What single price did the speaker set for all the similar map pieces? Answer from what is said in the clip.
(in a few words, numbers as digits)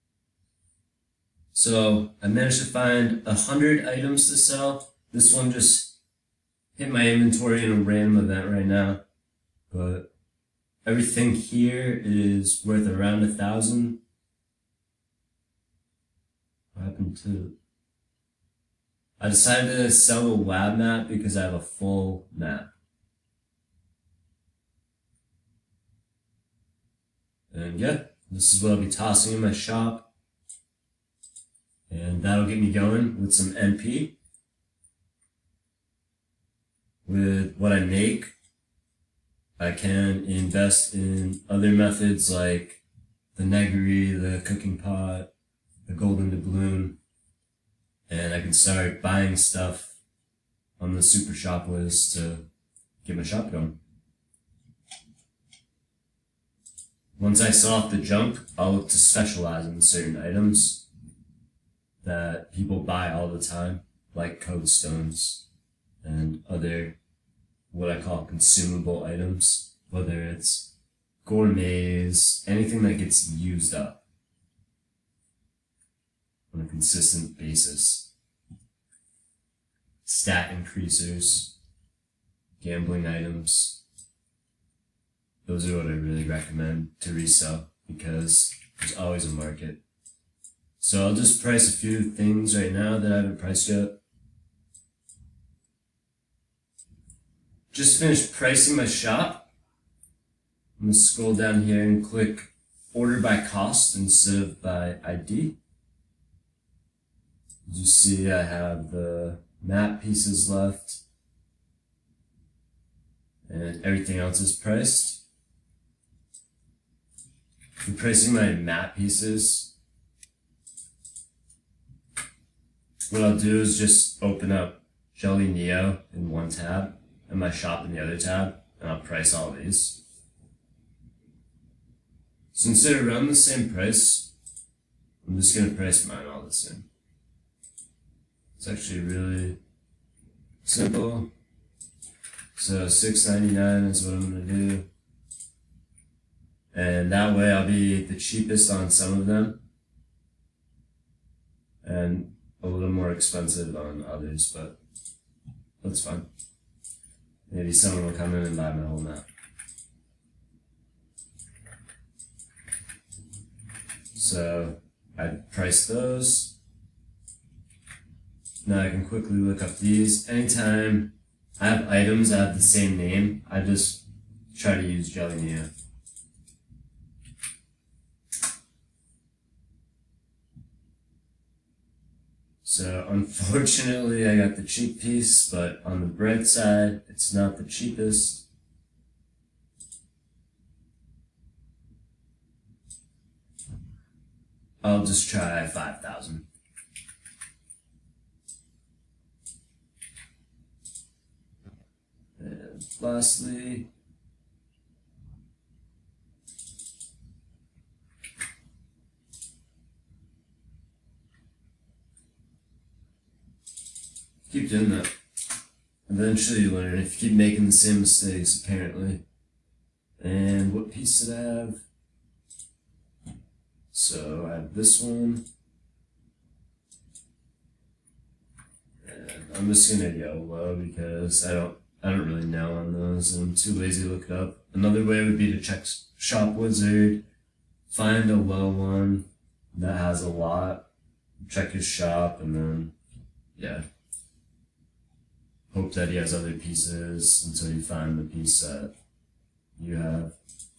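699.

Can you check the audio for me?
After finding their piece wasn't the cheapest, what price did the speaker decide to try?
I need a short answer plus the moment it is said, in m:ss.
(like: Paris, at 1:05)
5,000, at 3:15.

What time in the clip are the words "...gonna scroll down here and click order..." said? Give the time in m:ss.
1:40.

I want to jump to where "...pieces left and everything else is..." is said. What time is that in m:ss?
1:50.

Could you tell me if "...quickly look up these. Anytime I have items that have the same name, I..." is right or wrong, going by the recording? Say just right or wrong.
right.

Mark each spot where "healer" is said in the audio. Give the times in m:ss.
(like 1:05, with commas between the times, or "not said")
not said.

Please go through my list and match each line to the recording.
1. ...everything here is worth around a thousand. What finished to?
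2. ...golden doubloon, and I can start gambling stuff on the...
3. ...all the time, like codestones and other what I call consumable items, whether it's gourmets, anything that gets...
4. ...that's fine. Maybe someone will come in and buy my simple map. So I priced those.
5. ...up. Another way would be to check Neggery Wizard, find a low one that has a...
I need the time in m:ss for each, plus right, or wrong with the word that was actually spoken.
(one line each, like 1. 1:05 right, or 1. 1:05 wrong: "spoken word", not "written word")
1. 0:10 wrong: "happened", not "finished"
2. 0:45 wrong: "buying", not "gambling"
3. 1:03 right
4. 2:35 wrong: "whole", not "simple"
5. 3:54 wrong: "Shop", not "Neggery".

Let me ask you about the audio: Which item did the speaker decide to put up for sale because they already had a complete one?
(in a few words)
the lab map.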